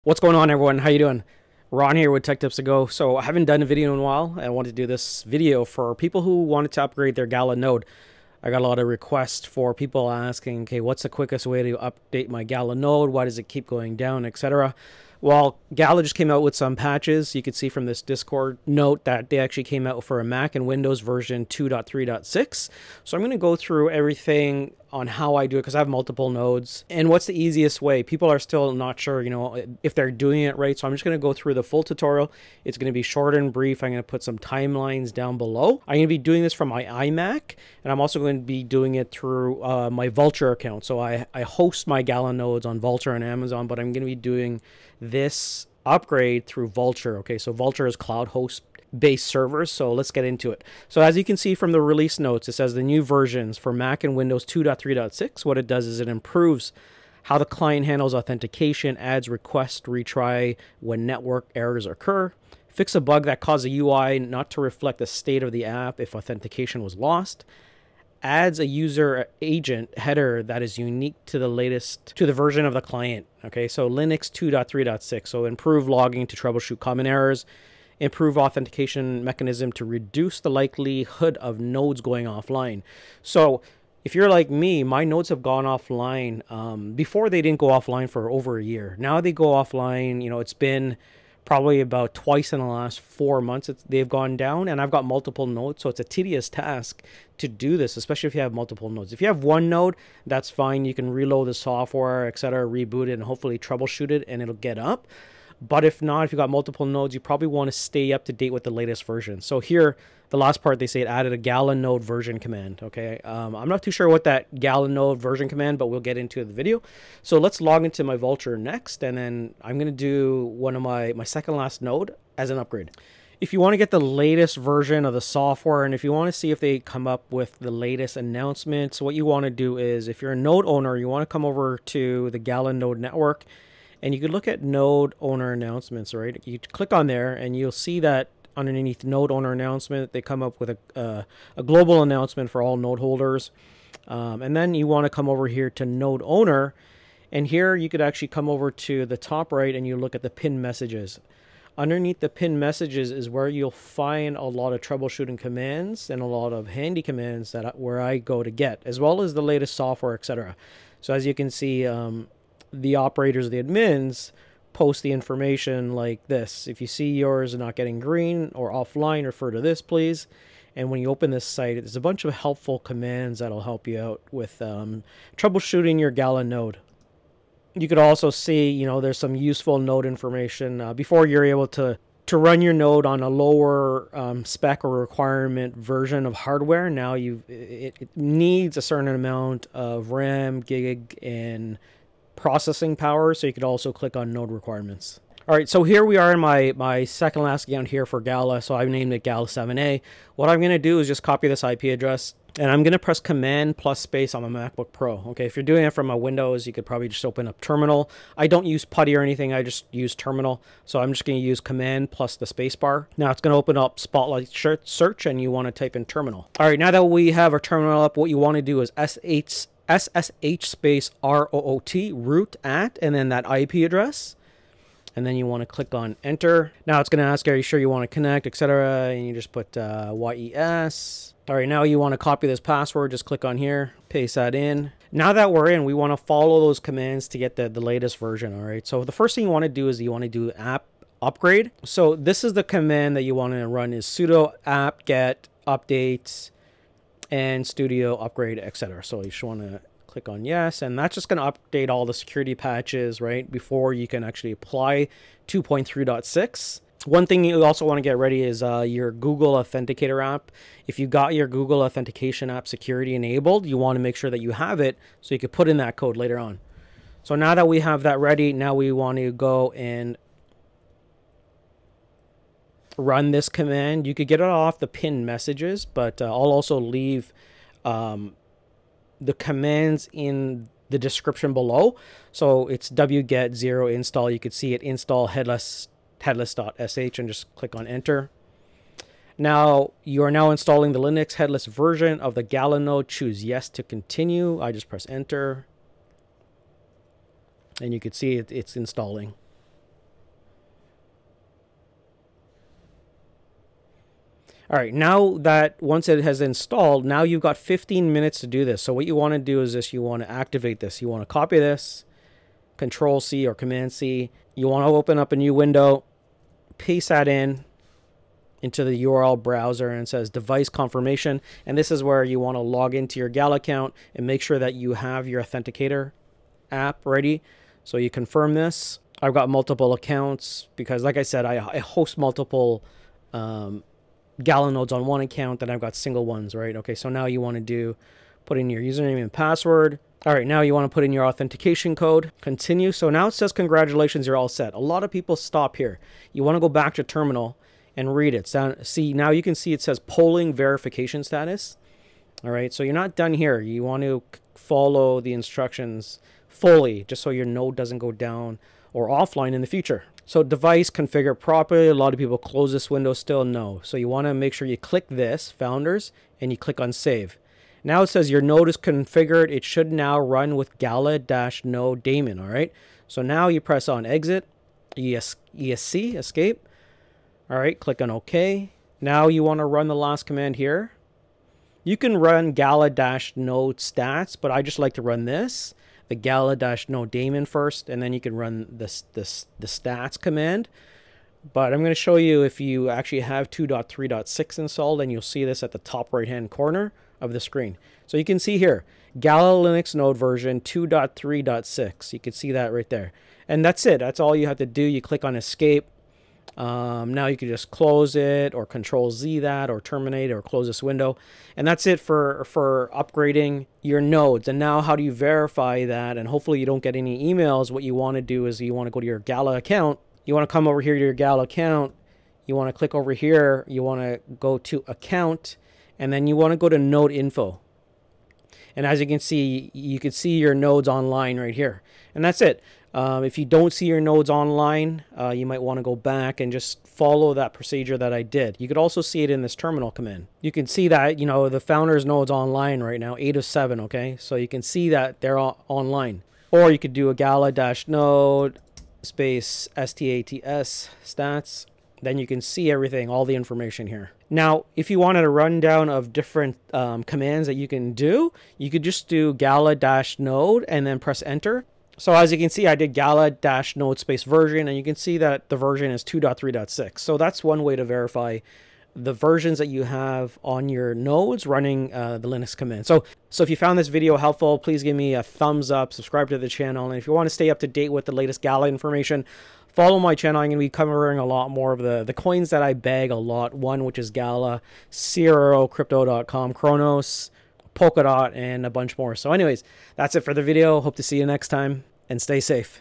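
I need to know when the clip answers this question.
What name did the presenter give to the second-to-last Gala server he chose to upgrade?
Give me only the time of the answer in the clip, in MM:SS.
03:19.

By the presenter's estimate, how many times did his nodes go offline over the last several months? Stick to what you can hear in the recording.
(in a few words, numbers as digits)
twice.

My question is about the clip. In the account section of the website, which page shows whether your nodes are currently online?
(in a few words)
node info.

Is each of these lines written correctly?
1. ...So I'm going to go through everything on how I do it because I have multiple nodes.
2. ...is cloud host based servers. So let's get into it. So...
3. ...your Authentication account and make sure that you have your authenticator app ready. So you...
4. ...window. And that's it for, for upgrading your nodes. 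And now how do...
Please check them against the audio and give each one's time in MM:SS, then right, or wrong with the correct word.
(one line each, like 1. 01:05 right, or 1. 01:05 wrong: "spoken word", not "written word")
1. 00:23 right
2. 00:47 right
3. 05:23 wrong: "Gal", not "Authentication"
4. 06:50 right.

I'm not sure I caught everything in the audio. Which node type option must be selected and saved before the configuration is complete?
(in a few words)
Founders.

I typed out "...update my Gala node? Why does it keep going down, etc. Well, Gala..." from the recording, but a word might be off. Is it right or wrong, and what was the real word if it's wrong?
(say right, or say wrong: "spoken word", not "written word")
right.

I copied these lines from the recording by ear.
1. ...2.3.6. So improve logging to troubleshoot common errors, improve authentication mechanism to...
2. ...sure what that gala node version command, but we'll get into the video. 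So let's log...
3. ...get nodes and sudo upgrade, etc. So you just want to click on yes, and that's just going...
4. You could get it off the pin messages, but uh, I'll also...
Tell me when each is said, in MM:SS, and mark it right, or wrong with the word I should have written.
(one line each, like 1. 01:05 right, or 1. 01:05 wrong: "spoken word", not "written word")
1. 01:14 right
2. 01:53 right
3. 04:05 wrong: "updates", not "nodes"
4. 04:34 right.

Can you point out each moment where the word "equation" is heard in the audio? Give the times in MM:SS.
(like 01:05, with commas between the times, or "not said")
not said.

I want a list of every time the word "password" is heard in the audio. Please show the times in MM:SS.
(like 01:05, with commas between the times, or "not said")
03:52, 05:39.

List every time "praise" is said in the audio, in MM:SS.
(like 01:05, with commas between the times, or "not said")
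not said.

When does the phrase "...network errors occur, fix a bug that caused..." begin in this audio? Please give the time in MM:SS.
01:01.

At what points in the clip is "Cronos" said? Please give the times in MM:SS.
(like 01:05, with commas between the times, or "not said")
08:06.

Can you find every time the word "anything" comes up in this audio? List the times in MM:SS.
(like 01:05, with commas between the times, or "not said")
03:29.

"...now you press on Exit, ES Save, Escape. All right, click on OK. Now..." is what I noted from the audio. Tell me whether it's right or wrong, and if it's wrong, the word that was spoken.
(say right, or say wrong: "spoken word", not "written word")
wrong: "ESC", not "Save".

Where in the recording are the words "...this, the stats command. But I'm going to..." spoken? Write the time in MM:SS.
06:29.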